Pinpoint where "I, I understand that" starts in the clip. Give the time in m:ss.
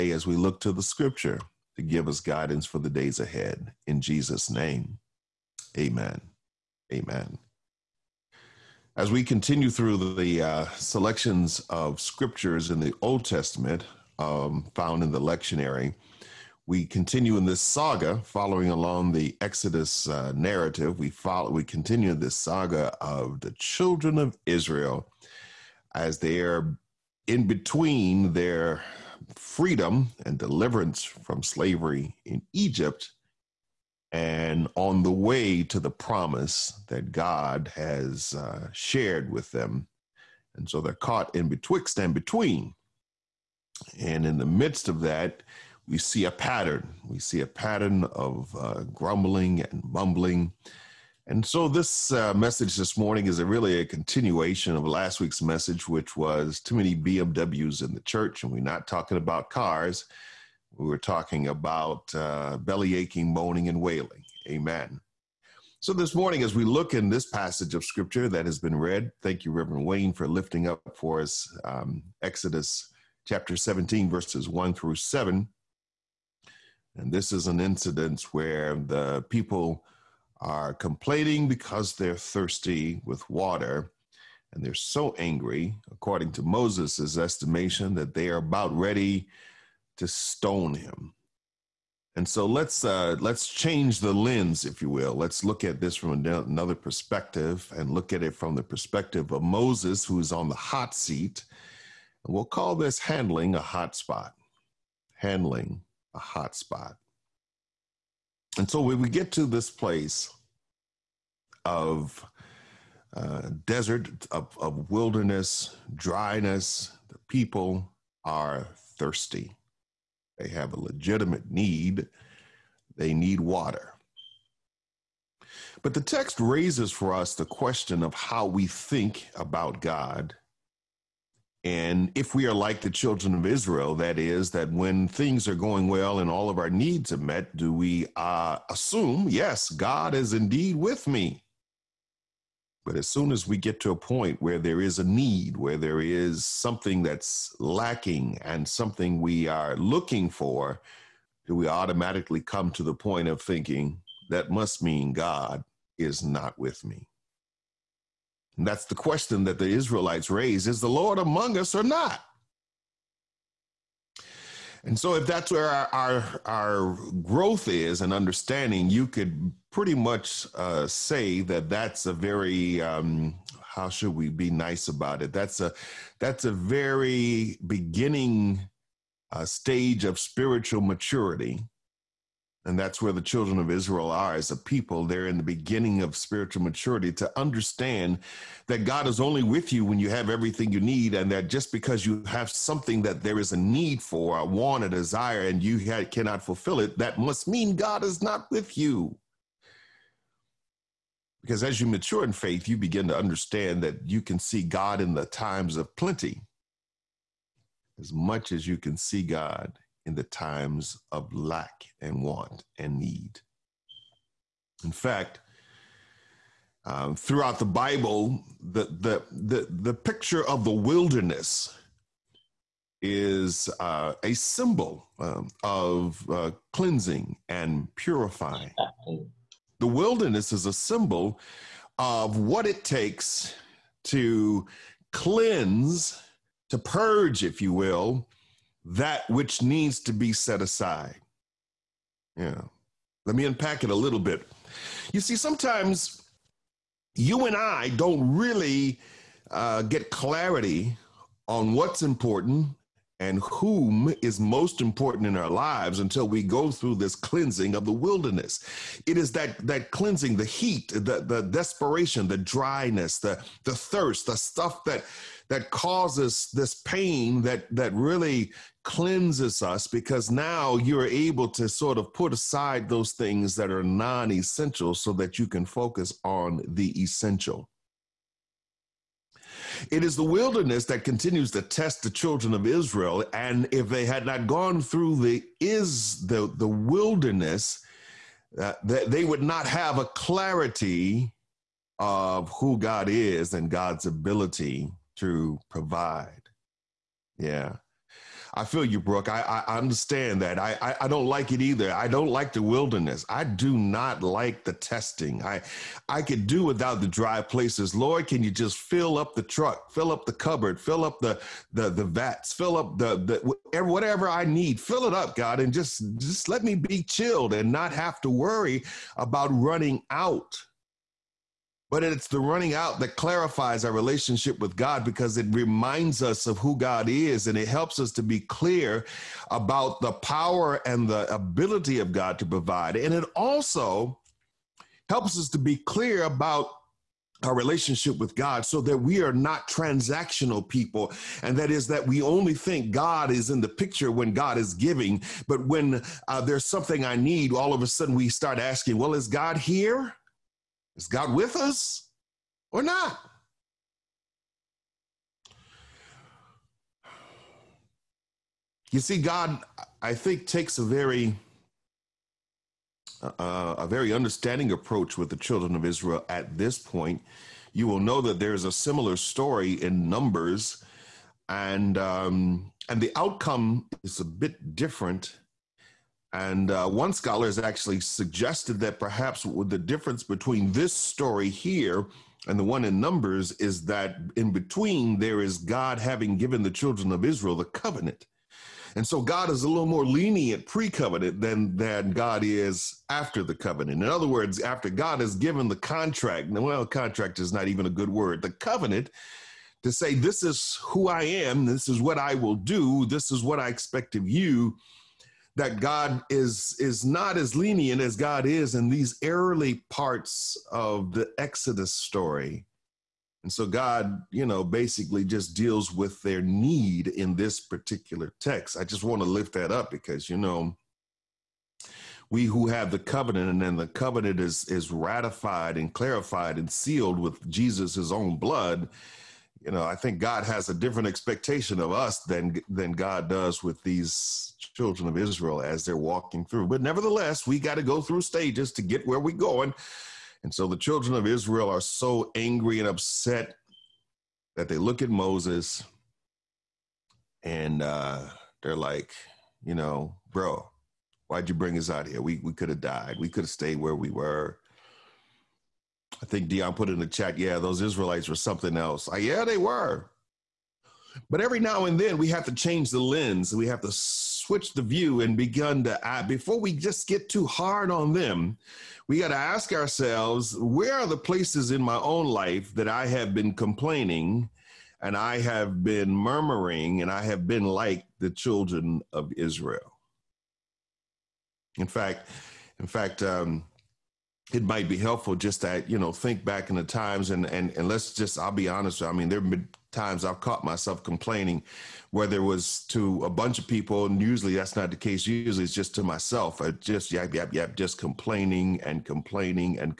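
4:59.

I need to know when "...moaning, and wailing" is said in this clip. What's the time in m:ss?
1:03.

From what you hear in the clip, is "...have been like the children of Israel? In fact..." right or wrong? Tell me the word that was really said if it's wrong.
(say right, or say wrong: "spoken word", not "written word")
right.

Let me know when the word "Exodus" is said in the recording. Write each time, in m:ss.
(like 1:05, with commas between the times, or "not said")
0:19, 1:12, 6:51.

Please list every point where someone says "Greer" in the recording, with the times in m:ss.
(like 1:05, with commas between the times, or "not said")
not said.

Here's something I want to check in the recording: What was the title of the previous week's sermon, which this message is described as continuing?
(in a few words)
Too many BMWs in the church.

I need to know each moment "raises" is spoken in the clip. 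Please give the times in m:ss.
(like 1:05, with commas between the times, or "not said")
2:06, 2:40.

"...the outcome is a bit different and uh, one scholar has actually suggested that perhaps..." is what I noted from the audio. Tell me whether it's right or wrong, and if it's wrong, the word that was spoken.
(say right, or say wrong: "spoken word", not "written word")
right.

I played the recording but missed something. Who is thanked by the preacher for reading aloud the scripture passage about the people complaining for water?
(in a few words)
Reverend Wayne.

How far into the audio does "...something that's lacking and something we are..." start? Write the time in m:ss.
2:26.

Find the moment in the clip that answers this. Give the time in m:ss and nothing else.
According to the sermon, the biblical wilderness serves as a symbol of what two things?
3:46.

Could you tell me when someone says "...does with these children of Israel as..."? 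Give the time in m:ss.
7:13.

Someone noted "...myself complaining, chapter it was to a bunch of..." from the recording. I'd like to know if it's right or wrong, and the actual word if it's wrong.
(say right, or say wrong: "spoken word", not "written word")
wrong: "whether", not "chapter".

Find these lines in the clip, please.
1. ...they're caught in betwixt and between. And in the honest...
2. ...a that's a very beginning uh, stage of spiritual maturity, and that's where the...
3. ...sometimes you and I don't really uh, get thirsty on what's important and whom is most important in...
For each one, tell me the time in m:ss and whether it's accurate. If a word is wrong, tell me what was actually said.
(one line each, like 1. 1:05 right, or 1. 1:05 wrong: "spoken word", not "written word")
1. 0:40 wrong: "midst", not "honest"
2. 2:55 right
3. 4:05 wrong: "clarity", not "thirsty".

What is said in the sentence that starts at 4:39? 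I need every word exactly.
It is the wilderness that continues to test the children of Israel.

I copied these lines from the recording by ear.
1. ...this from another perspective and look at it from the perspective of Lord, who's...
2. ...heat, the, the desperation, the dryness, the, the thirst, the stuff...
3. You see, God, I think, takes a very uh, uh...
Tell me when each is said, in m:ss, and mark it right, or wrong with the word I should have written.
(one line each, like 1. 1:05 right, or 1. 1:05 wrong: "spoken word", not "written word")
1. 1:35 wrong: "Moses", not "Lord"
2. 4:20 right
3. 5:58 right.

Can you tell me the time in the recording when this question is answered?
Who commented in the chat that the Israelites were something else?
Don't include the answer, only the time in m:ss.
7:36.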